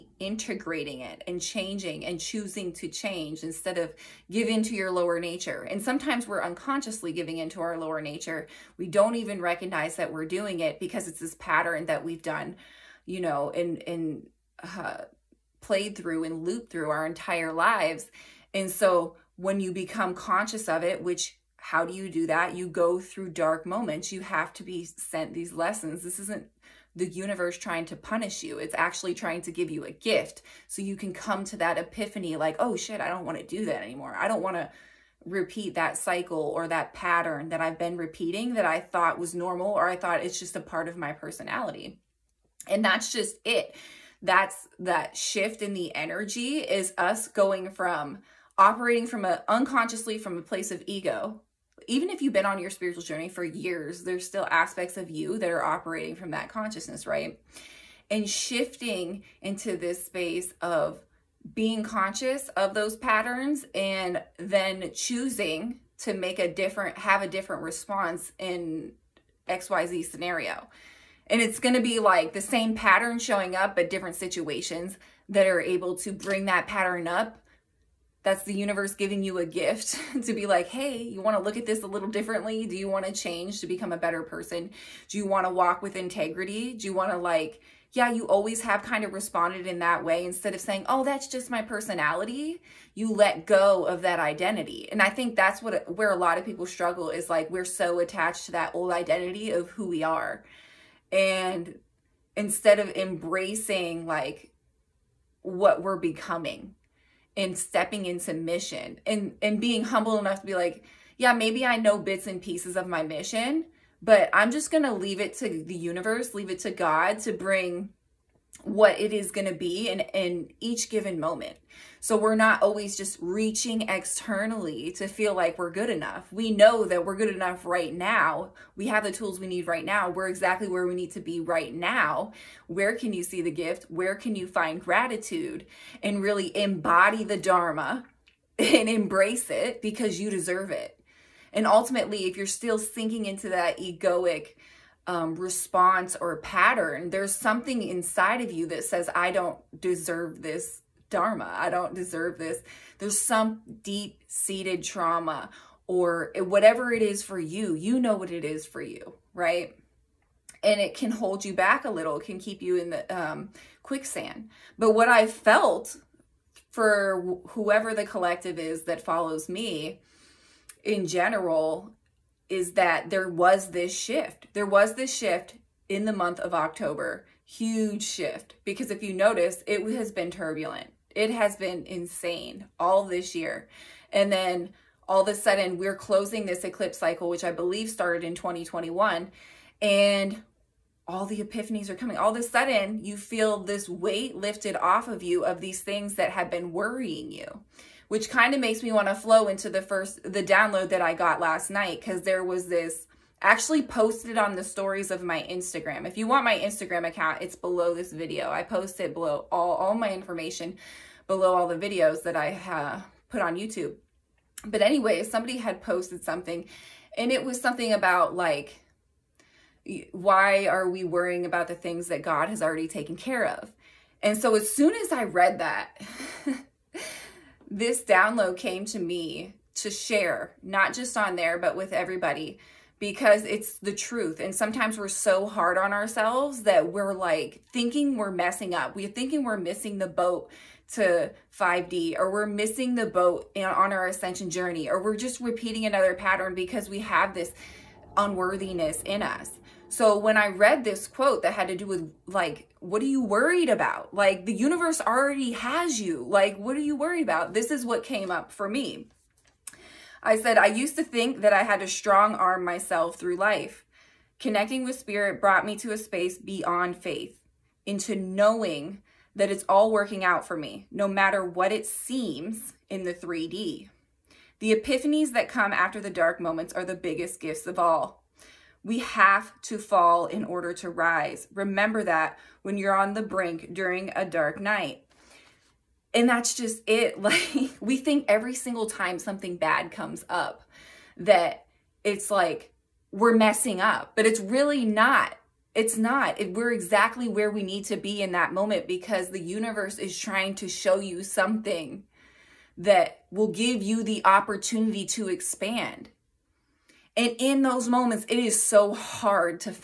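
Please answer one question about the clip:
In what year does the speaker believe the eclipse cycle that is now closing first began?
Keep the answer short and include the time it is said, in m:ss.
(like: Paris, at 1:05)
2021, at 3:08.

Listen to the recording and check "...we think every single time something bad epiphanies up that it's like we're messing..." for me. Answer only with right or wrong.
wrong.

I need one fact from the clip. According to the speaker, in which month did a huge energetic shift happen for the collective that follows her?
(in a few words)
October.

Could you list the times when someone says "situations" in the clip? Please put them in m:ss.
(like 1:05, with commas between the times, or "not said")
1:14.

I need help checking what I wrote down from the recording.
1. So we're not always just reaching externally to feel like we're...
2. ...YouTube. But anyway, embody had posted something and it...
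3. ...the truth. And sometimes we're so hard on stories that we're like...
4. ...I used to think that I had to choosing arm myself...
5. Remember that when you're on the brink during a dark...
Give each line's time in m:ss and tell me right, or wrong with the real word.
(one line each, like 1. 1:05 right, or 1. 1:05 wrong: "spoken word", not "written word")
1. 2:01 right
2. 3:33 wrong: "somebody", not "embody"
3. 3:53 wrong: "ourselves", not "stories"
4. 4:20 wrong: "strong", not "choosing"
5. 4:41 right.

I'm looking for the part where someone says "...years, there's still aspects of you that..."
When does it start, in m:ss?
0:53.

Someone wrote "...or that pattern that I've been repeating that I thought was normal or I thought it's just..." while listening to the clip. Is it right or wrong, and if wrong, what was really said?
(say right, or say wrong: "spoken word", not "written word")
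right.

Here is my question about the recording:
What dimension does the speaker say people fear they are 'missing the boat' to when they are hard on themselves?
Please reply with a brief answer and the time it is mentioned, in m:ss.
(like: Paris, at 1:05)
5D, at 4:01.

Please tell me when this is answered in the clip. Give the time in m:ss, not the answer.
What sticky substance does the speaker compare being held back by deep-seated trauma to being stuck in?
2:43.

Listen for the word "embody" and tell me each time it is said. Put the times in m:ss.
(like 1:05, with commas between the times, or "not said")
2:16.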